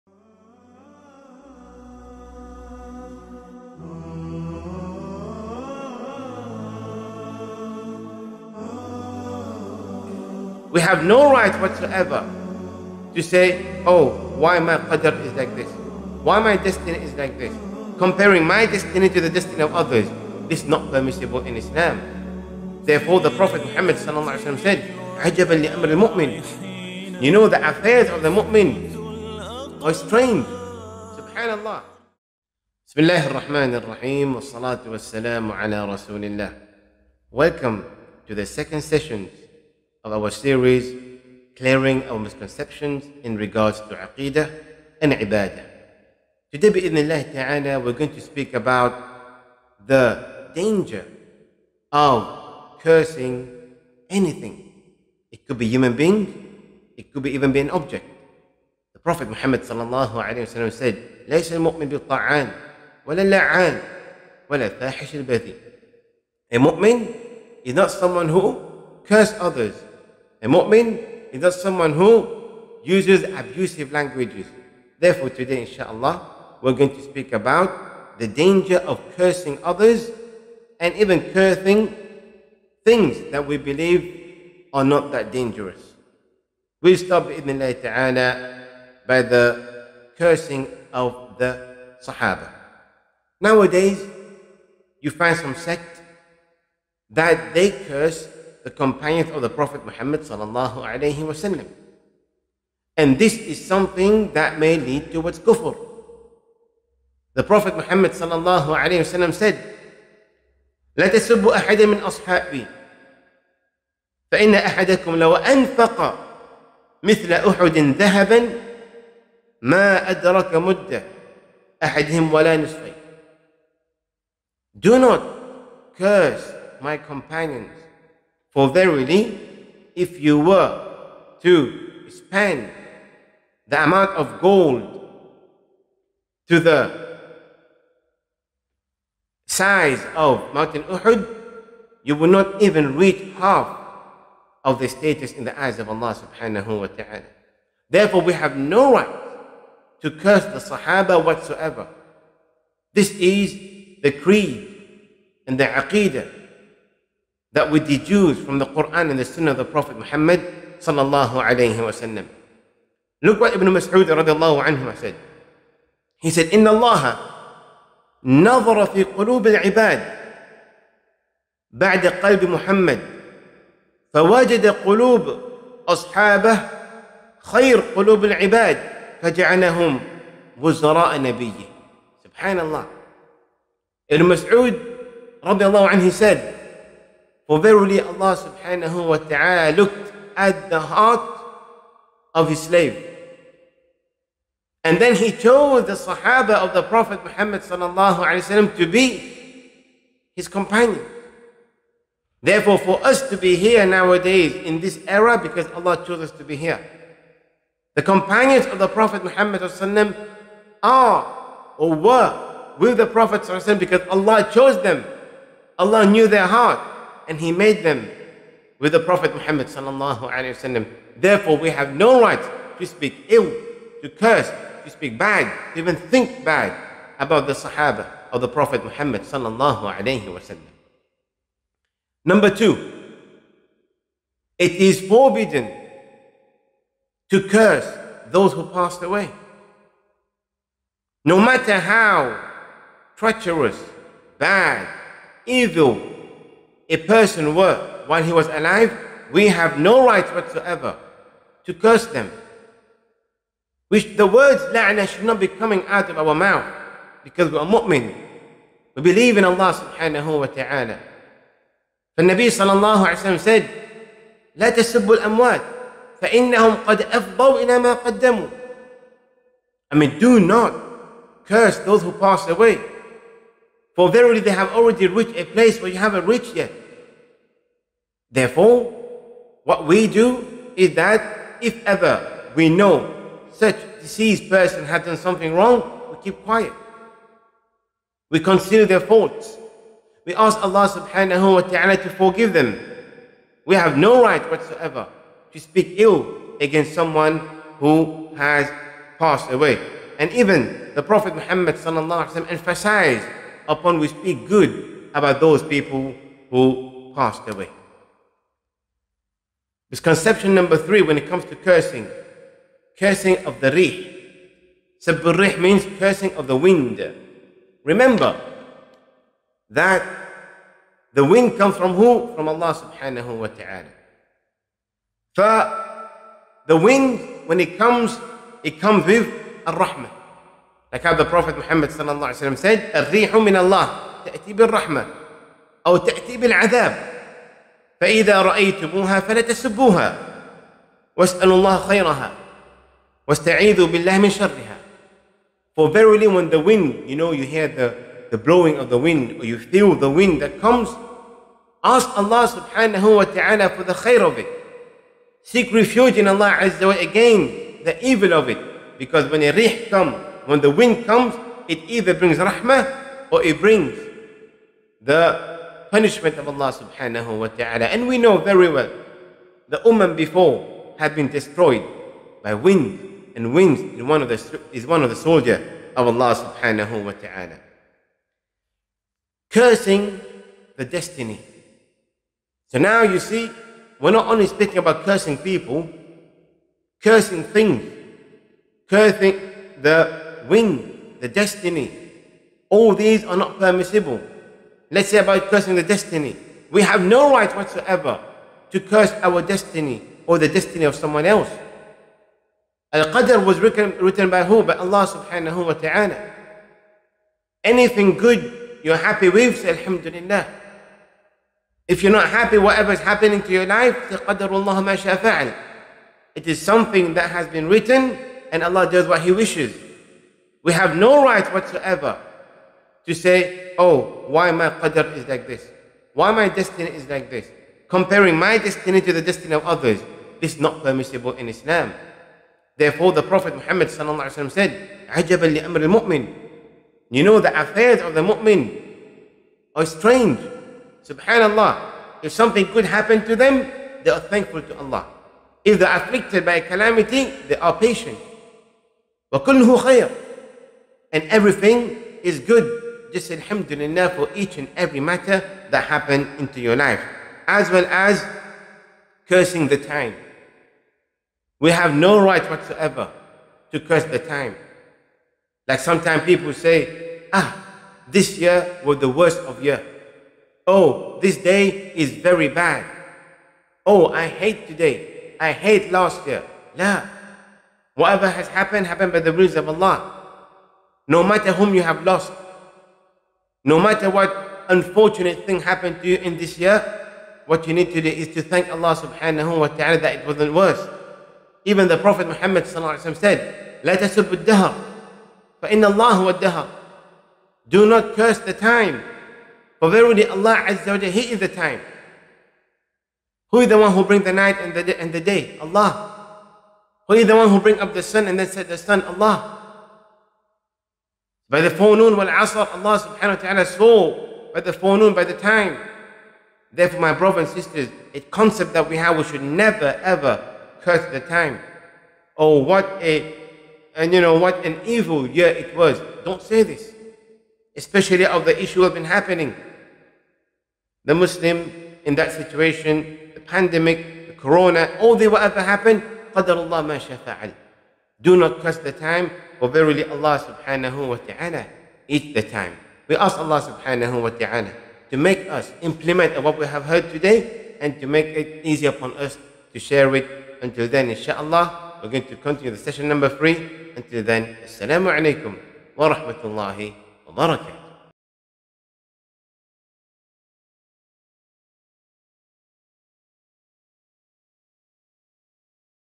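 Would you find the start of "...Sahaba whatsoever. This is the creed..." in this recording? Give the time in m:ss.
2:30.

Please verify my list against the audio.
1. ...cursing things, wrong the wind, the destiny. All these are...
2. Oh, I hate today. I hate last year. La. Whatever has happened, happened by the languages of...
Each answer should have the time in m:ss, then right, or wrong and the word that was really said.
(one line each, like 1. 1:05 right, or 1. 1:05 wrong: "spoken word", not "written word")
1. 6:27 wrong: "cursing", not "wrong"
2. 7:53 wrong: "rules", not "languages".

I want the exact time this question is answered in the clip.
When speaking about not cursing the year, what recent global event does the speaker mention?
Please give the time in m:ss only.
8:54.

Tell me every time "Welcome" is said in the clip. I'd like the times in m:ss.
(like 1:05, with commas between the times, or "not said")
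0:37.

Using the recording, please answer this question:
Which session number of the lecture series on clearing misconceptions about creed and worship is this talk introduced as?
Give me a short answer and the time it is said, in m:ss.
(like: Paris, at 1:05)
second, at 0:38.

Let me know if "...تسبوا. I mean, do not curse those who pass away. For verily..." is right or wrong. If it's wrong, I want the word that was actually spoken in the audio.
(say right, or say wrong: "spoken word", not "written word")
wrong: "قدموا", not "تسبوا".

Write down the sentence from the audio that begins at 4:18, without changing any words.
We believe in Allah subhanahu wa ta'ala.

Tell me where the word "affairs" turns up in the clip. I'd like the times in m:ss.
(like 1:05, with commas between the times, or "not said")
0:27, 7:17.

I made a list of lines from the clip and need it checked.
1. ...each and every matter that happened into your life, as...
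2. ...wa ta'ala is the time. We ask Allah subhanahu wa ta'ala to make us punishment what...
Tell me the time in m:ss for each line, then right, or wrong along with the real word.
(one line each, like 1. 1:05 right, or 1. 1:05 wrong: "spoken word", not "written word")
1. 7:34 right
2. 9:01 wrong: "implement", not "punishment".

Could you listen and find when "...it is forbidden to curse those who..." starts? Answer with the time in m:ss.
3:54.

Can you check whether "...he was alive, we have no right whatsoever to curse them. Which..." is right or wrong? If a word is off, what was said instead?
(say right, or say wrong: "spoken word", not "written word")
right.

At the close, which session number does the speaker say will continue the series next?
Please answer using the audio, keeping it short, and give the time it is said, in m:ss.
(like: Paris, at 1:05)
3, at 9:12.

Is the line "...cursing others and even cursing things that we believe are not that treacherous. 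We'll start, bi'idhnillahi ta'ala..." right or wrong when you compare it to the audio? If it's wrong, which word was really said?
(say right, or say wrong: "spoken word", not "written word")
wrong: "dangerous", not "treacherous".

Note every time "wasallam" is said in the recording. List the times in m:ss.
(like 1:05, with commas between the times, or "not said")
1:41, 1:49, 3:40, 3:50, 5:02.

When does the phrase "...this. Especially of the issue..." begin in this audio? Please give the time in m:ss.
8:46.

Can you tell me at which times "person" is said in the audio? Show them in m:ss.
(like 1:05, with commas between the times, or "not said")
4:06, 4:44.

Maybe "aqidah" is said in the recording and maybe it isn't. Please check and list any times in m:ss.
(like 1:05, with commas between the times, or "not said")
0:43, 2:35.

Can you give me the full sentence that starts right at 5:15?
rih means cursing of the wind.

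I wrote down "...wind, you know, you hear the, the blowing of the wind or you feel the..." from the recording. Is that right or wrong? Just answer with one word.
right.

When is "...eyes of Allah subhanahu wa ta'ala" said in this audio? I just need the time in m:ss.
2:25.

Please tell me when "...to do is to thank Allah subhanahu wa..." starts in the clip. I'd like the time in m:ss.
8:07.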